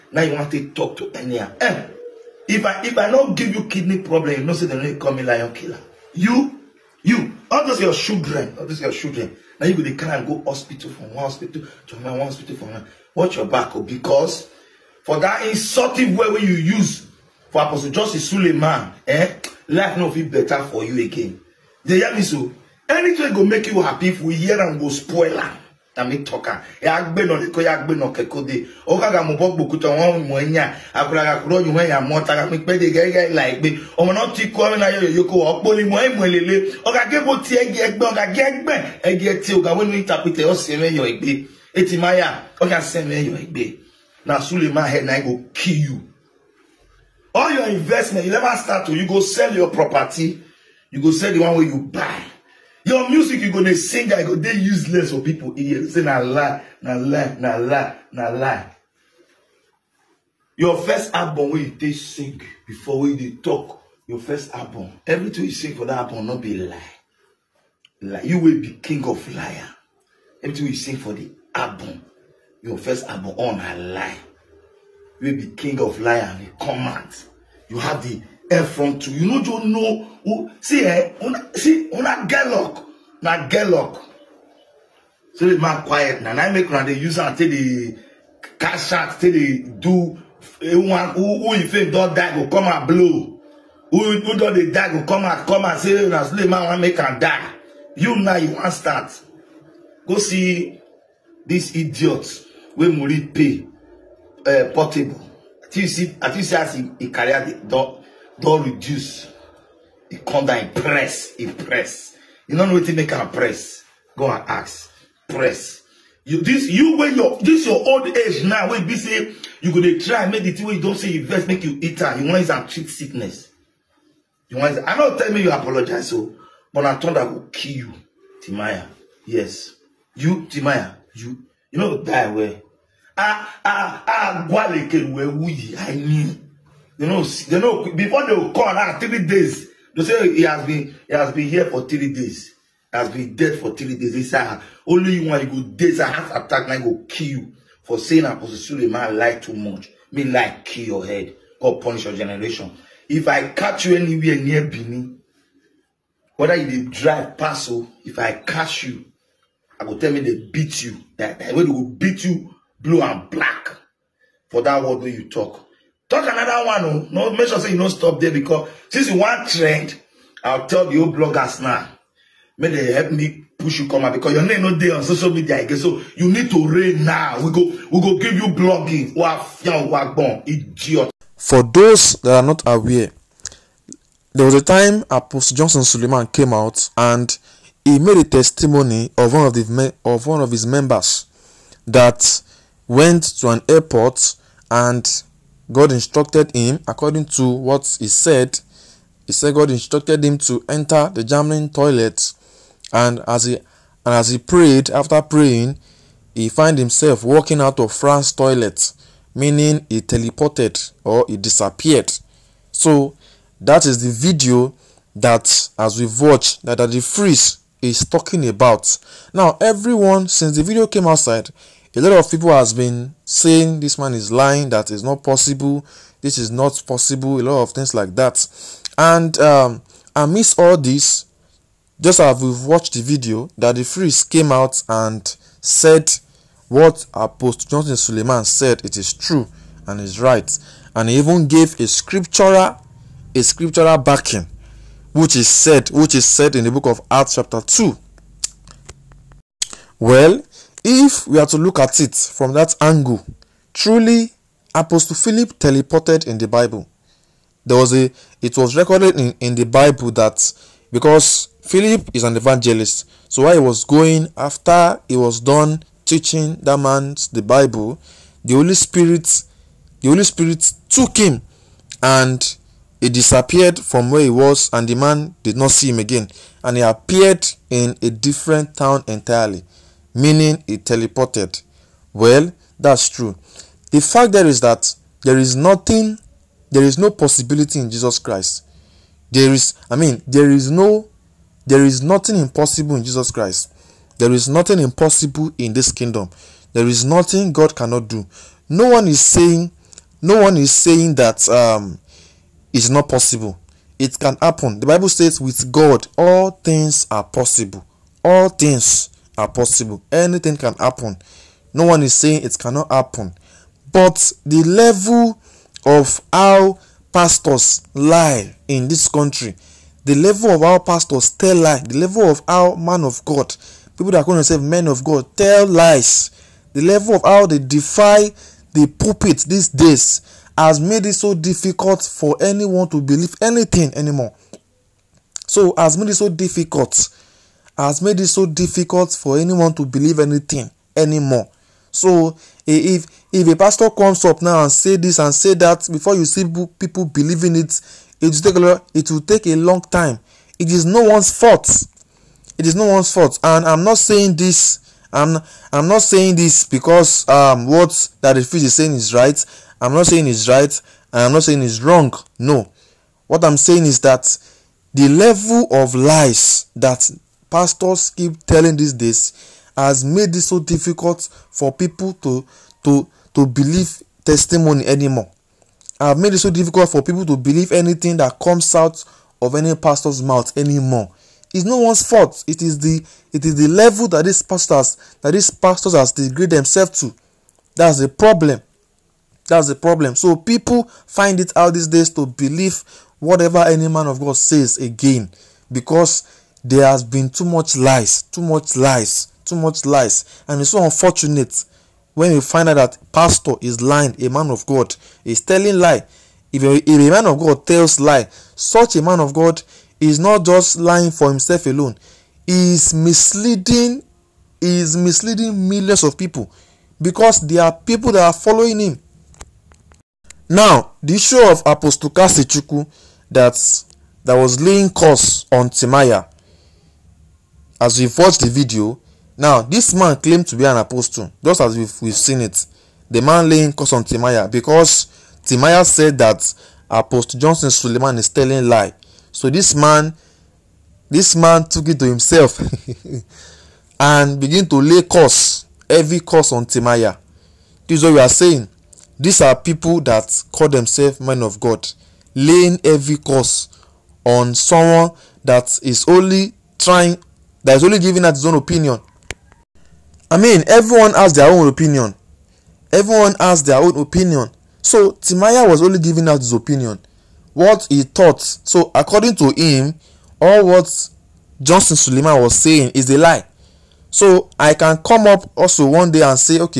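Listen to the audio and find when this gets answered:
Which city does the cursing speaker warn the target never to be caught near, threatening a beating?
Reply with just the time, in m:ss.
2:34.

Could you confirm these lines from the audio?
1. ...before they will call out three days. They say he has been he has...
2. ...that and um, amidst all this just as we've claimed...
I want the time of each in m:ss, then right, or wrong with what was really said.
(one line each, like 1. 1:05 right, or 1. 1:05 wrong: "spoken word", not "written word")
1. 2:17 right
2. 3:48 wrong: "watched", not "claimed".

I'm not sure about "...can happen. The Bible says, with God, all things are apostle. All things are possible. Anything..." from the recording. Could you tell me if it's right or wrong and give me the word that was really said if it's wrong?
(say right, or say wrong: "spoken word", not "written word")
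wrong: "possible", not "apostle".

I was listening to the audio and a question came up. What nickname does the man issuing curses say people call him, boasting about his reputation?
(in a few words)
lion killer.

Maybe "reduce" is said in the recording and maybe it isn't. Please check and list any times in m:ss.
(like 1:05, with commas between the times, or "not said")
1:48.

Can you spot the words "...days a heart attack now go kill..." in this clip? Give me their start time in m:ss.
2:25.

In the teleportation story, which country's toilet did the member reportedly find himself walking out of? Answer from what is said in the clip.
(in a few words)
France.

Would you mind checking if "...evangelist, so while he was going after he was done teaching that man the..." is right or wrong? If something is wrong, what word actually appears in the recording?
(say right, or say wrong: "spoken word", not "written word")
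right.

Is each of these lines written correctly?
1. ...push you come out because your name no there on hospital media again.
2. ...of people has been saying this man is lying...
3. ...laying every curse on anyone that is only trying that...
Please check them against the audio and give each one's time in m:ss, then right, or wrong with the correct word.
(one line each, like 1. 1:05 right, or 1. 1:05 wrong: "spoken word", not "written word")
1. 2:53 wrong: "social", not "hospital"
2. 3:42 right
3. 7:32 wrong: "someone", not "anyone".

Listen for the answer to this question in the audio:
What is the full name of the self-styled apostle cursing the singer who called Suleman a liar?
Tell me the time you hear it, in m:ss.
7:02.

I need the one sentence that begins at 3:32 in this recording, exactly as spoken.
So that is the video that, as we've watched, that, that Daddy Freeze is talking about.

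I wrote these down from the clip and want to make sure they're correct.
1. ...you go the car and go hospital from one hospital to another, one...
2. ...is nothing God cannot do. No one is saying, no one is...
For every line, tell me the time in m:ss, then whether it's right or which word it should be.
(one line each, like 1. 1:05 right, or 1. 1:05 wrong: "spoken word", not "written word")
1. 0:09 right
2. 4:56 right.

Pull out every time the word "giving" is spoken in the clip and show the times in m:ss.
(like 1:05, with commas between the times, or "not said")
7:37, 7:45.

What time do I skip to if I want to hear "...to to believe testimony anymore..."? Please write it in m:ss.
6:12.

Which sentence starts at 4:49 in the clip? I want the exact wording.
There is, I mean, there is no, there is nothing impossible in Jesus Christ.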